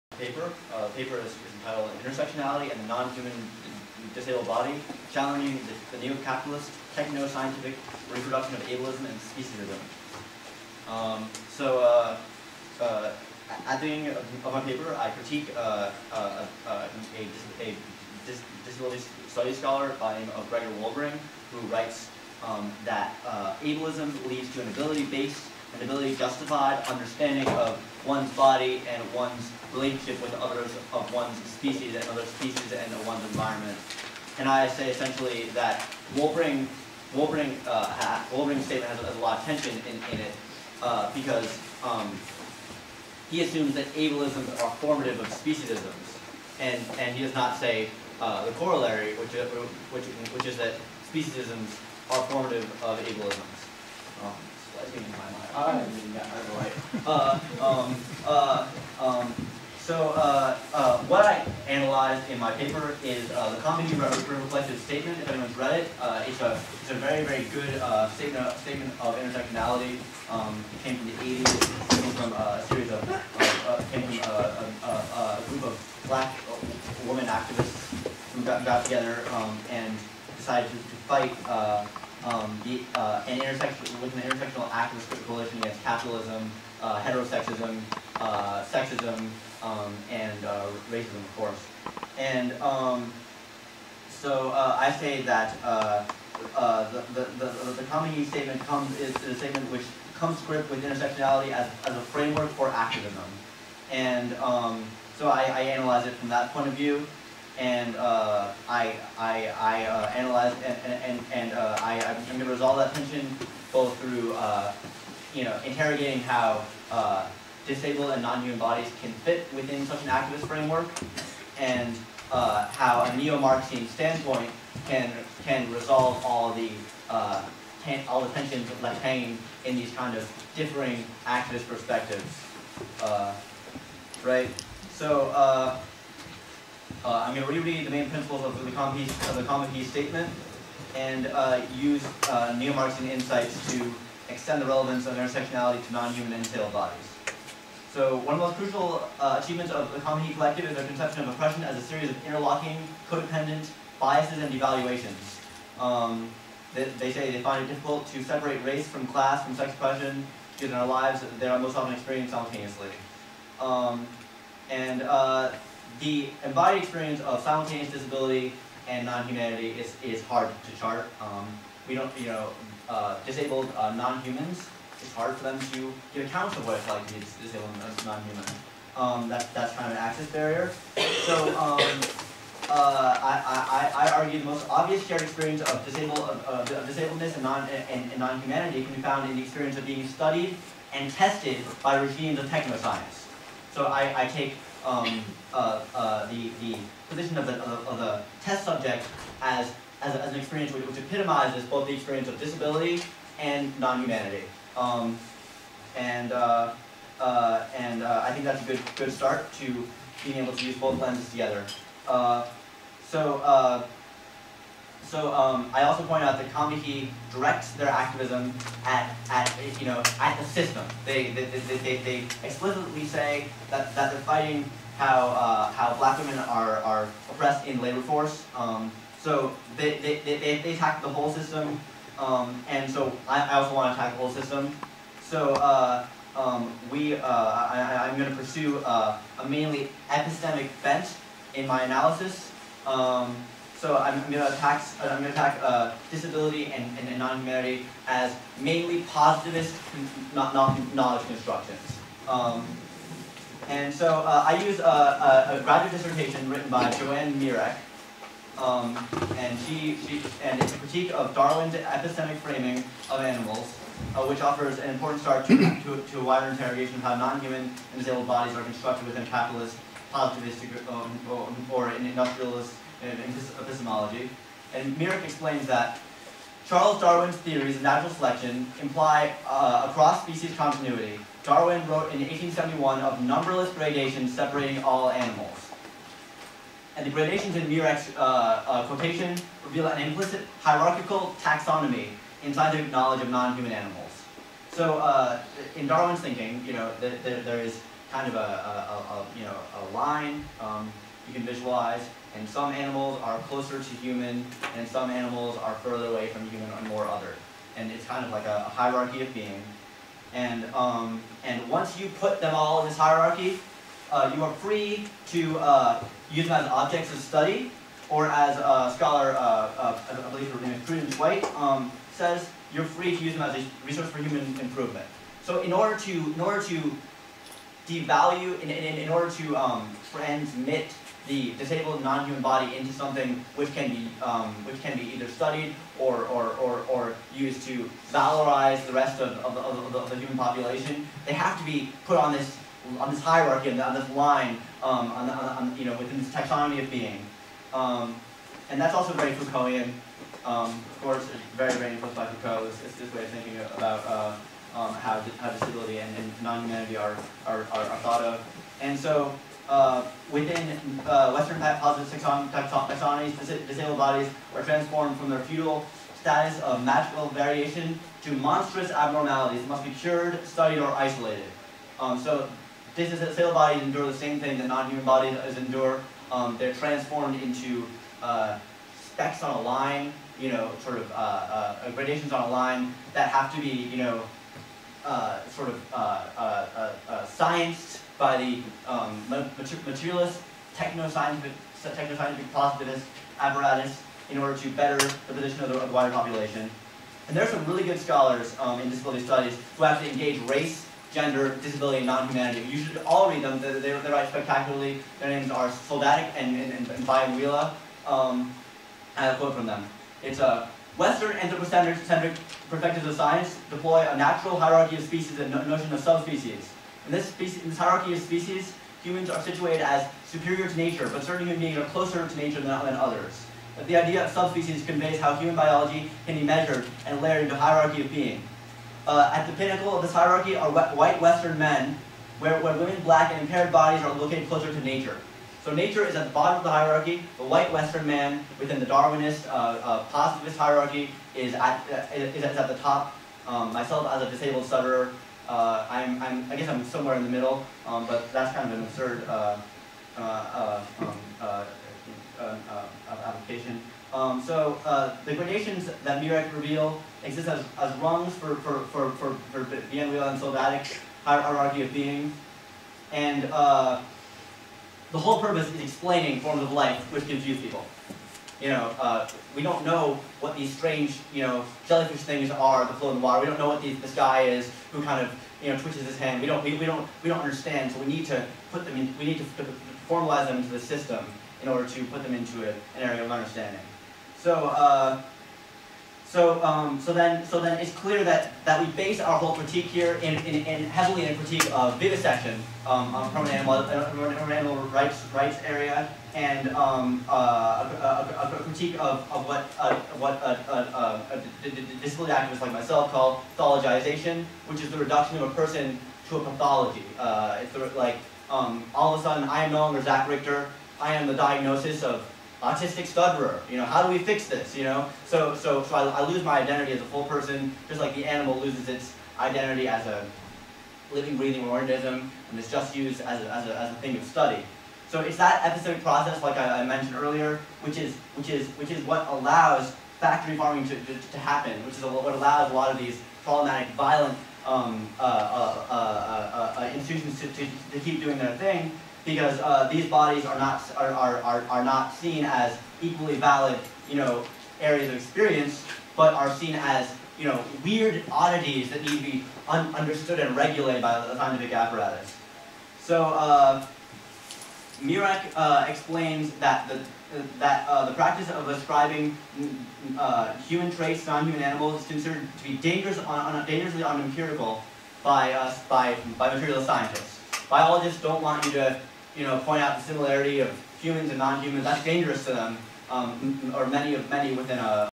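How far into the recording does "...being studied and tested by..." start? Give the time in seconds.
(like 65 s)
189 s.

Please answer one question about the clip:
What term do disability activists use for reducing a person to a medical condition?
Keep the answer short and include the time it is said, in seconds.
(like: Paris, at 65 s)
pathologization, at 503 s.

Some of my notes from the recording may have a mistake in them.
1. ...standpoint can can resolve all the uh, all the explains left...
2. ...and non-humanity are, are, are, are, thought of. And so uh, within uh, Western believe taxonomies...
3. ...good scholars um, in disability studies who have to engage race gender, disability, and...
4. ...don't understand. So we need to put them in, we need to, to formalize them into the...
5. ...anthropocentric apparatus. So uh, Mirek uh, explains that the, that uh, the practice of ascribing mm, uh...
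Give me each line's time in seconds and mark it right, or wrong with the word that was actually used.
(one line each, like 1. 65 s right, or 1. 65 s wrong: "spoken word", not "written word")
1. 123 s wrong: "tensions", not "explains"
2. 356 s wrong: "positive", not "believe"
3. 397 s right
4. 477 s right
5. 551 s wrong: "scientific", not "anthropocentric".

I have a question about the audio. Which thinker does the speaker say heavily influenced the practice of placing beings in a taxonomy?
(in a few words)
Foucault.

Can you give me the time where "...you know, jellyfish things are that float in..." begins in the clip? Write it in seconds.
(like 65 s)
471 s.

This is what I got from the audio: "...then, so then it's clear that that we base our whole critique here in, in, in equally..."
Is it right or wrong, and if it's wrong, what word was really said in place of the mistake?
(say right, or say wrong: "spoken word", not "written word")
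wrong: "heavily", not "equally".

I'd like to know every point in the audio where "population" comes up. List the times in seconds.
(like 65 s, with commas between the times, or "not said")
340 s, 396 s.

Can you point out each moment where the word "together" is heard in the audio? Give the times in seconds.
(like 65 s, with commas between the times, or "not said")
78 s, 211 s.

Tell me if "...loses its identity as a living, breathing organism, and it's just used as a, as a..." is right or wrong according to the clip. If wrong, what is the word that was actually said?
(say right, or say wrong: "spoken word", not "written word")
right.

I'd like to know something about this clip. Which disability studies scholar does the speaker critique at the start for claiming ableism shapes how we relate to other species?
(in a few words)
Gregor Wolbring.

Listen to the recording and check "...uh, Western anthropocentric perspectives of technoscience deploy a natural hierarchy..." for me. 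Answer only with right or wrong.
wrong.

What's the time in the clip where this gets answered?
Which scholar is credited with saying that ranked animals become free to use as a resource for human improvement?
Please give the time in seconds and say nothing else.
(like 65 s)
320 s.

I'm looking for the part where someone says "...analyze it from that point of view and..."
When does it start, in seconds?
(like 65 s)
105 s.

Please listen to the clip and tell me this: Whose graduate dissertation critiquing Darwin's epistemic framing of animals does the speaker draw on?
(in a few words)
Joanne Mirek.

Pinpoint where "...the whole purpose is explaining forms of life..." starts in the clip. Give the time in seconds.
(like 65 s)
465 s.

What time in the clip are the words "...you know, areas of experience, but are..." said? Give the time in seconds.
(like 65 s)
544 s.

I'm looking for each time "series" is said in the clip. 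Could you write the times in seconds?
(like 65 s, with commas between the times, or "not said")
72 s, 151 s.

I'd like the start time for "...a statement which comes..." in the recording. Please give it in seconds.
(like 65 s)
99 s.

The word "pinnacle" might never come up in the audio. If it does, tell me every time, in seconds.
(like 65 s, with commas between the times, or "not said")
429 s.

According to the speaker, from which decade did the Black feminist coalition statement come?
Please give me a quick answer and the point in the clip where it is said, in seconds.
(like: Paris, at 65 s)
the 80s, at 71 s.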